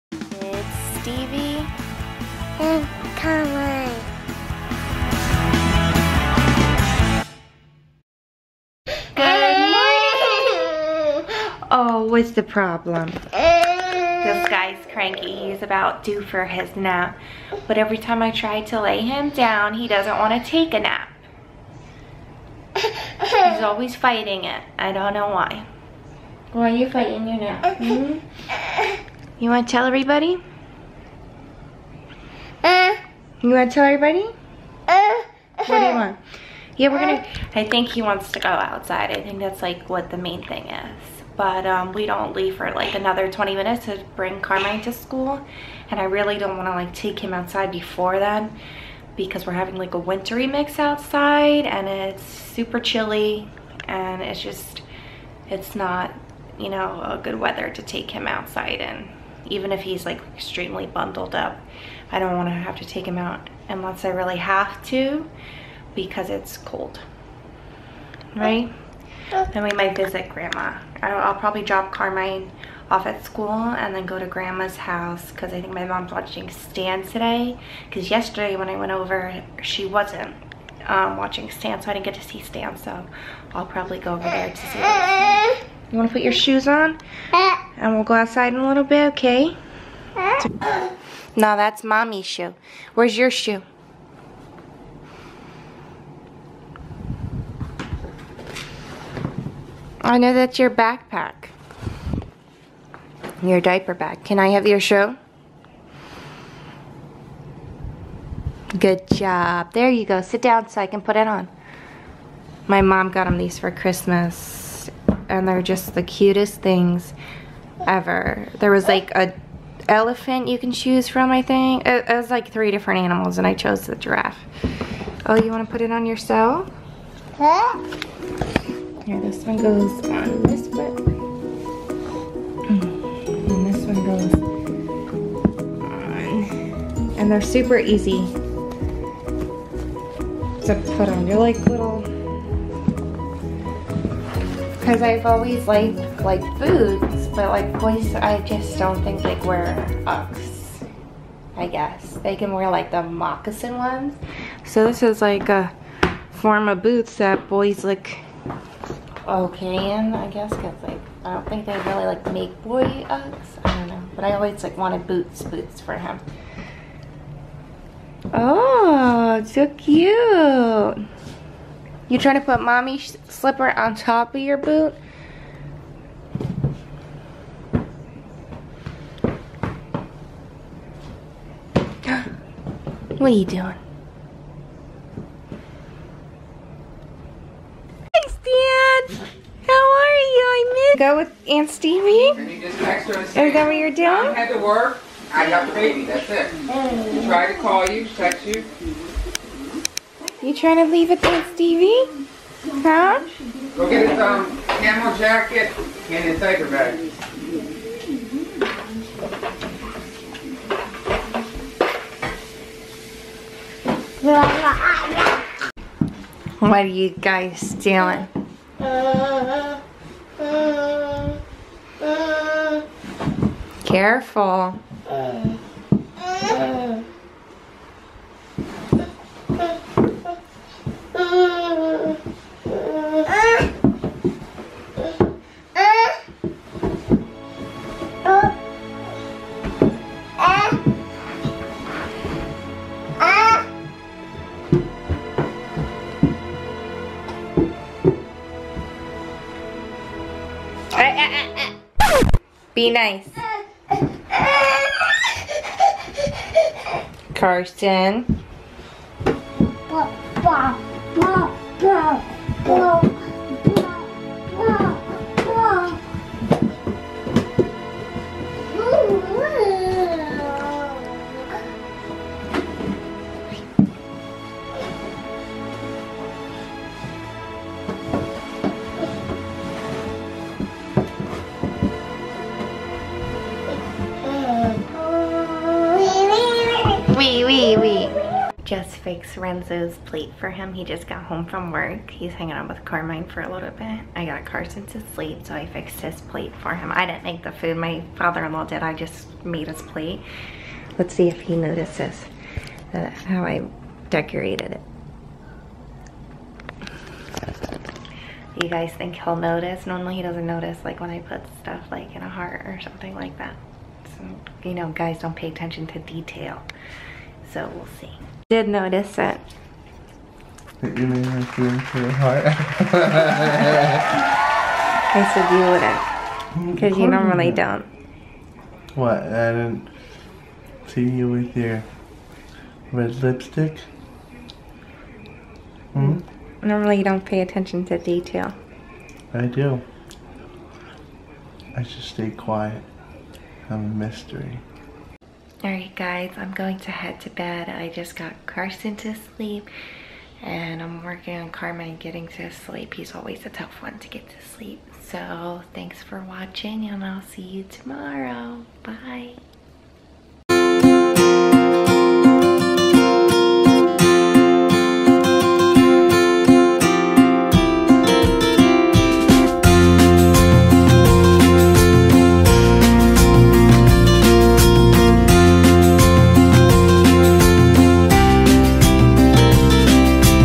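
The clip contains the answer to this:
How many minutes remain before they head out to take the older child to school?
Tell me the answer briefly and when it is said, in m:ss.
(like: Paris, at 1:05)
20, at 0:43.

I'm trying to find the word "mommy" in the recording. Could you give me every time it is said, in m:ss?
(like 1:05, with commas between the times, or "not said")
1:31, 2:52.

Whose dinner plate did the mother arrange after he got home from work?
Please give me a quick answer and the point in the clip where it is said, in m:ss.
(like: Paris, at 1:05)
Renzo, at 4:49.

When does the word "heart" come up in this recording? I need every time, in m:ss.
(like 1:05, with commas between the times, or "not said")
5:12, 5:22.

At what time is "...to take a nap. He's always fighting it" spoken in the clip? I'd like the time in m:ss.
0:20.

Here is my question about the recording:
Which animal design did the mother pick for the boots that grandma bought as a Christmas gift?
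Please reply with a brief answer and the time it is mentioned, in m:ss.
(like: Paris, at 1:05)
Giraffe, at 2:03.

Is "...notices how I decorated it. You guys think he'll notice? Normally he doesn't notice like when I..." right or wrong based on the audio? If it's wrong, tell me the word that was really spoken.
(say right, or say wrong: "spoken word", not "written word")
right.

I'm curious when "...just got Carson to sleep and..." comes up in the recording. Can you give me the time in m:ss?
5:47.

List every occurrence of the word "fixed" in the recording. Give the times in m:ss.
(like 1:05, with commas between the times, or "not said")
4:48, 4:55.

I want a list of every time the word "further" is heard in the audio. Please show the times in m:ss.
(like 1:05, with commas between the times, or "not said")
not said.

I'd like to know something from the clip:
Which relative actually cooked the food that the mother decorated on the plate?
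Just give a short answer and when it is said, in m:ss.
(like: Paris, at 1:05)
Father-in-law, at 4:58.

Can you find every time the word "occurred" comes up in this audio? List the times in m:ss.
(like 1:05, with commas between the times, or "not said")
not said.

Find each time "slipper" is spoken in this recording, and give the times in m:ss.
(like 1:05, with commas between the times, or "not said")
2:53.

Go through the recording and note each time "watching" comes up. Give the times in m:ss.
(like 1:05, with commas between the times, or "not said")
1:16, 1:21, 5:56.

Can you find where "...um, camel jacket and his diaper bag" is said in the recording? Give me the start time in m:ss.
3:24.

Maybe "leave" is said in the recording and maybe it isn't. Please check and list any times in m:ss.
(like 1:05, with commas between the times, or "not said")
0:42, 3:20.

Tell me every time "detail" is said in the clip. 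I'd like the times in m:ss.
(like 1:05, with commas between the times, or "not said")
5:15, 5:37.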